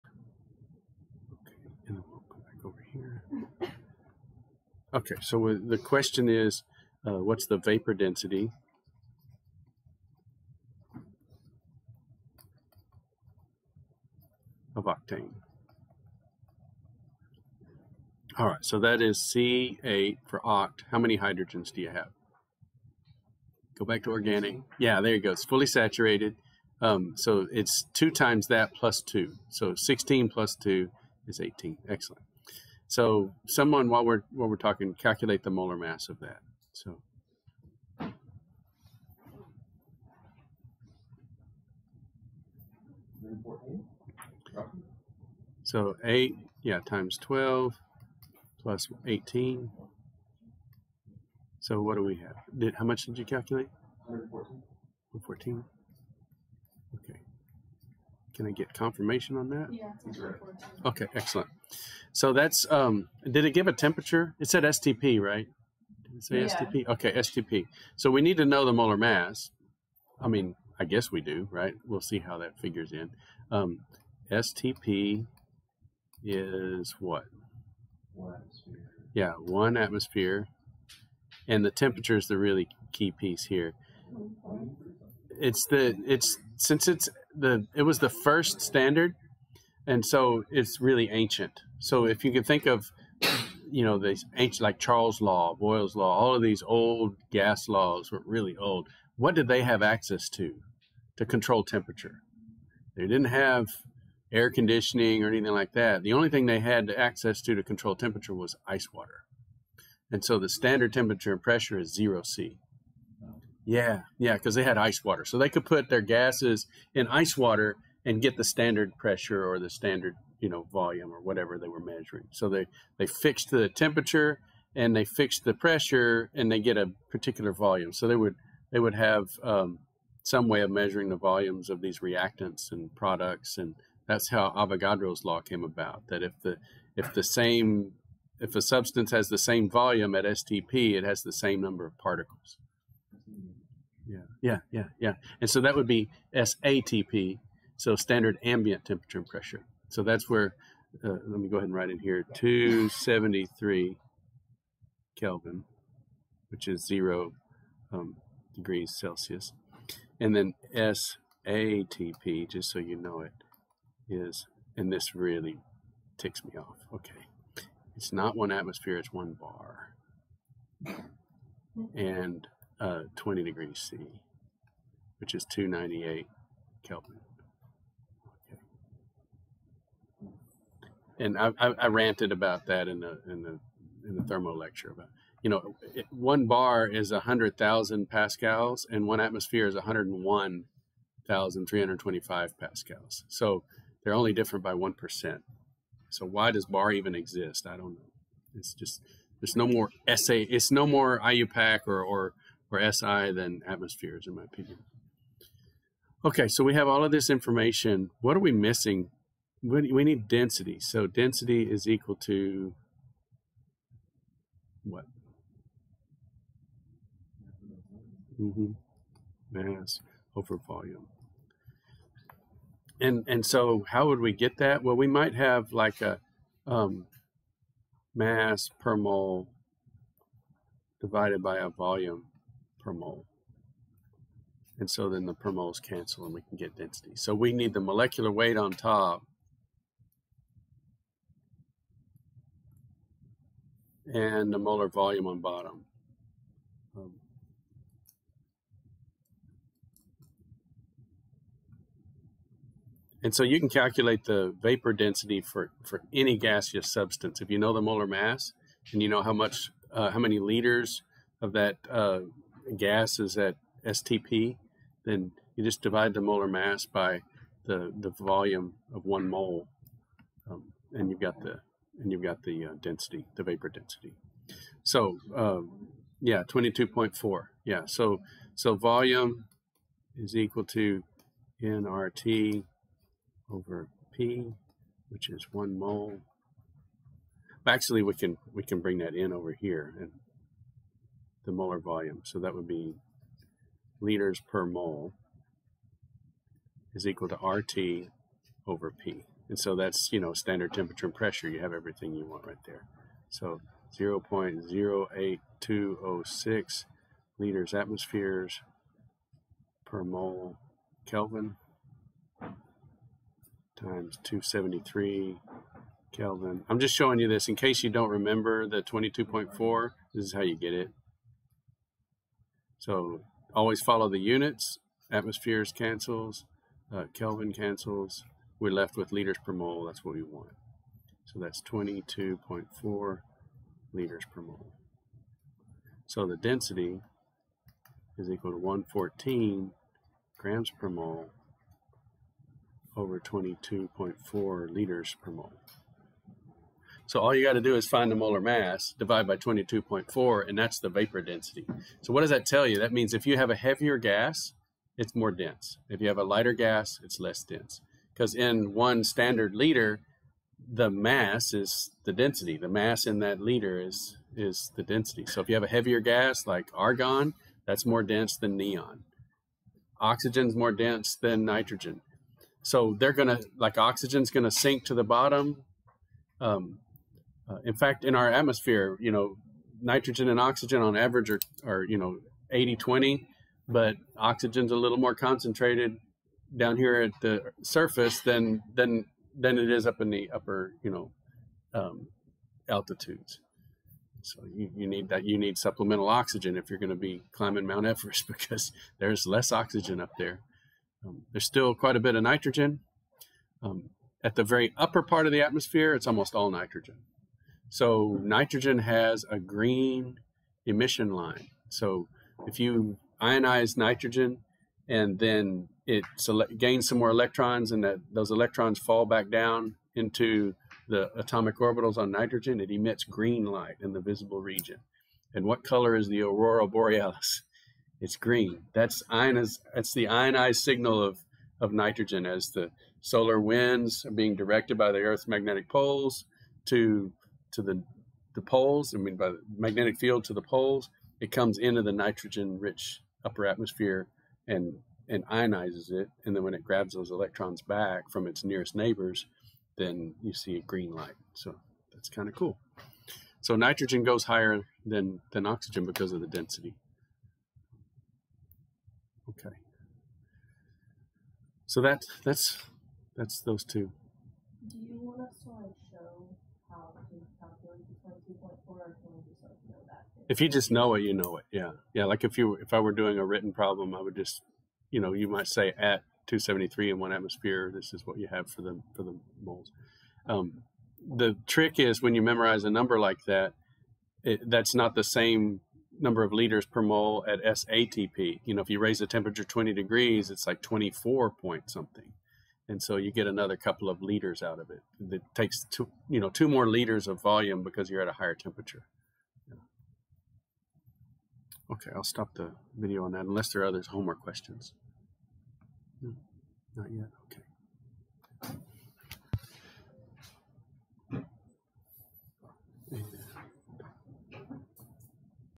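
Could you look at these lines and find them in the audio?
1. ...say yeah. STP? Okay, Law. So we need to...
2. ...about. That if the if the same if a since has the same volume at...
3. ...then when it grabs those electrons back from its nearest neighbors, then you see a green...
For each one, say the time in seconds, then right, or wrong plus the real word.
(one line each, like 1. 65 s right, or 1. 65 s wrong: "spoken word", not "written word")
1. 66 s wrong: "STP", not "Law"
2. 135 s wrong: "substance", not "since"
3. 446 s right.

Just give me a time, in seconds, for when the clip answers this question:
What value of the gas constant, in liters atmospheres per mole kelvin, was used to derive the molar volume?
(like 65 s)
303 s.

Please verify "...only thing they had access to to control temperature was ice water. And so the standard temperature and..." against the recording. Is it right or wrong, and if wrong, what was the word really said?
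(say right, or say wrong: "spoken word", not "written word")
right.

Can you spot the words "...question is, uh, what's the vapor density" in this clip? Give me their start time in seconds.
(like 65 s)
5 s.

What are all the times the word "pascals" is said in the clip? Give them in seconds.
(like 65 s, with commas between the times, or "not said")
188 s, 192 s.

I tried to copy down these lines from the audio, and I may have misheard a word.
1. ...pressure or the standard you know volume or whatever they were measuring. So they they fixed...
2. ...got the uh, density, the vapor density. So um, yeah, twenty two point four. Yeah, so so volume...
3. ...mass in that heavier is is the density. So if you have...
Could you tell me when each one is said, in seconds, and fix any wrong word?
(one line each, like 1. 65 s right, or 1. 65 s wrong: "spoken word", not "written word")
1. 118 s right
2. 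272 s right
3. 362 s wrong: "liter", not "heavier".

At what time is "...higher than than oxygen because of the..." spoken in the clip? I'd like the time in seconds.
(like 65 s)
454 s.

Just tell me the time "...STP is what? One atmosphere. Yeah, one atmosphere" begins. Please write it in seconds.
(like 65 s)
74 s.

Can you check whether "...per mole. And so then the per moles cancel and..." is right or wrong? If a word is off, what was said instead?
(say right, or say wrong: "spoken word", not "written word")
right.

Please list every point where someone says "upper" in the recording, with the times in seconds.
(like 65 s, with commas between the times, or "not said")
390 s, 404 s, 443 s.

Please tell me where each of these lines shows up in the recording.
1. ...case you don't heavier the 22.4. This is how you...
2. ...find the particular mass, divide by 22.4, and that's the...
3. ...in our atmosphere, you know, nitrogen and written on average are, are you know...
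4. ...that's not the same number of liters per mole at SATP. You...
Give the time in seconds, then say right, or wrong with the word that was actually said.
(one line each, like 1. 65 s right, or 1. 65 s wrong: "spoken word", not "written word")
1. 317 s wrong: "remember", not "heavier"
2. 347 s wrong: "molar", not "particular"
3. 378 s wrong: "oxygen", not "written"
4. 484 s right.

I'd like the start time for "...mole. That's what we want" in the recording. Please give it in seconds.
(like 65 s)
329 s.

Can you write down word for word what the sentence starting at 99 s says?
What did they have access to to control temperature?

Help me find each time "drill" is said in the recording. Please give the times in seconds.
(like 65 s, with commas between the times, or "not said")
not said.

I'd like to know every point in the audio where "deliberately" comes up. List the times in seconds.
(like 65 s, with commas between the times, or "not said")
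not said.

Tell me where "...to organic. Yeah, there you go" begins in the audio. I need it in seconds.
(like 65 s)
24 s.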